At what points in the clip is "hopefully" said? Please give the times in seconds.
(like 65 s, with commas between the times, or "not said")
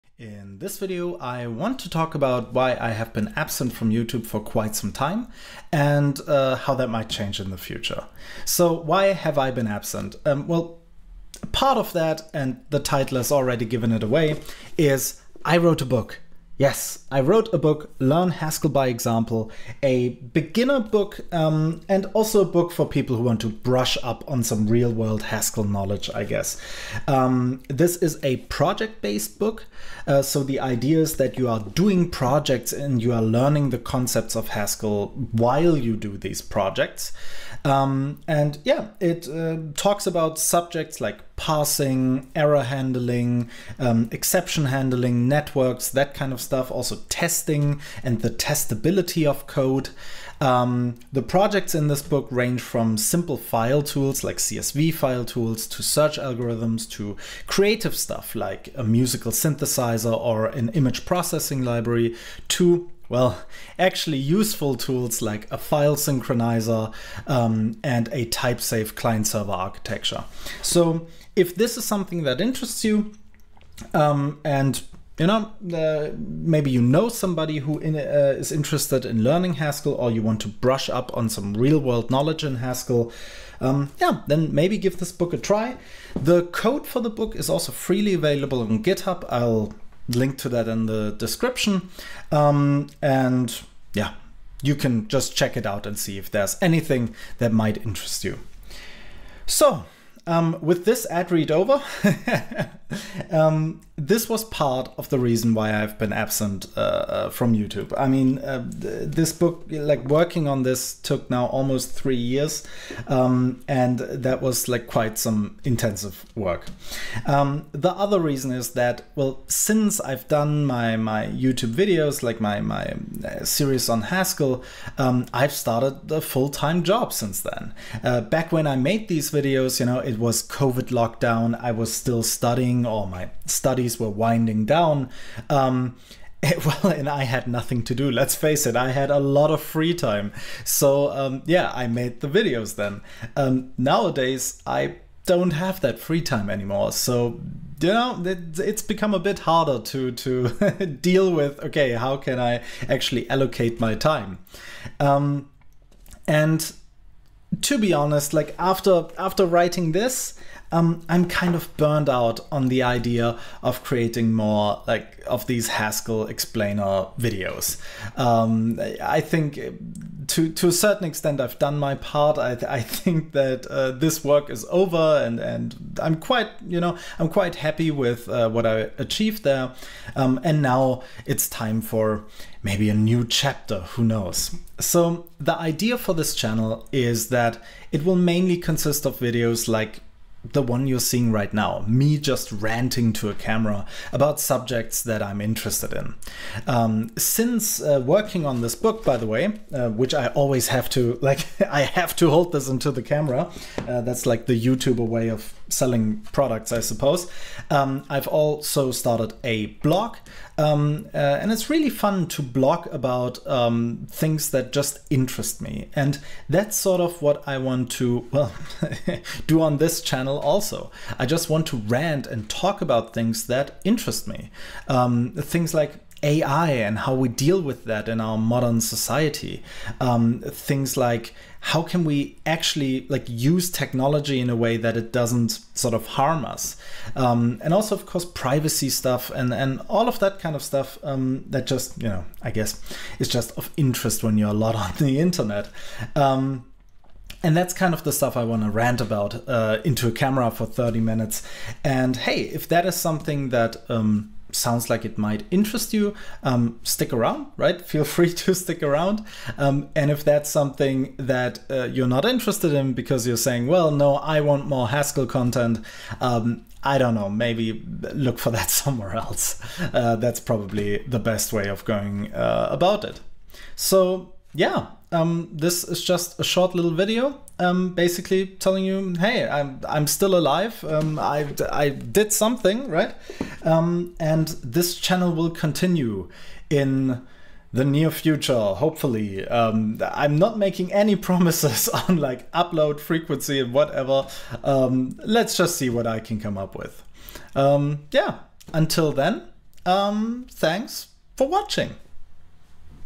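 288 s.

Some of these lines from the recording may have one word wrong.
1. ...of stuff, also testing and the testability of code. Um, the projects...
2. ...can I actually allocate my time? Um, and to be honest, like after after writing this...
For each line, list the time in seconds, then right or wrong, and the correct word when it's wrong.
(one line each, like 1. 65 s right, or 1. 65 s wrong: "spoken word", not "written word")
1. 46 s right
2. 152 s right.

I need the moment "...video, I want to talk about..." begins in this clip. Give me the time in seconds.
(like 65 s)
0 s.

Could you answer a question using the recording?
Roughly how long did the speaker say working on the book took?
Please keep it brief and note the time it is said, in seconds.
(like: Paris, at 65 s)
almost 3 years, at 111 s.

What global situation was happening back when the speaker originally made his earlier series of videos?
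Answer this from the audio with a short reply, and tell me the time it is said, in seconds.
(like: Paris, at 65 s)
COVID lockdown, at 130 s.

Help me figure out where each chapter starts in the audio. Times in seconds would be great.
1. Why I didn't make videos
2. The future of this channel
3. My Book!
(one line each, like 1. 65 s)
1. 102 s
2. 180 s
3. 14 s.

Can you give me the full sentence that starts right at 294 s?
Um, let's just see what I can come up with.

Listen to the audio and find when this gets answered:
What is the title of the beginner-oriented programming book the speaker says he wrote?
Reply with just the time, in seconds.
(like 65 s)
17 s.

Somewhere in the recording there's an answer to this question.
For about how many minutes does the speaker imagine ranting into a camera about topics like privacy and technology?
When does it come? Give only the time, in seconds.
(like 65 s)
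250 s.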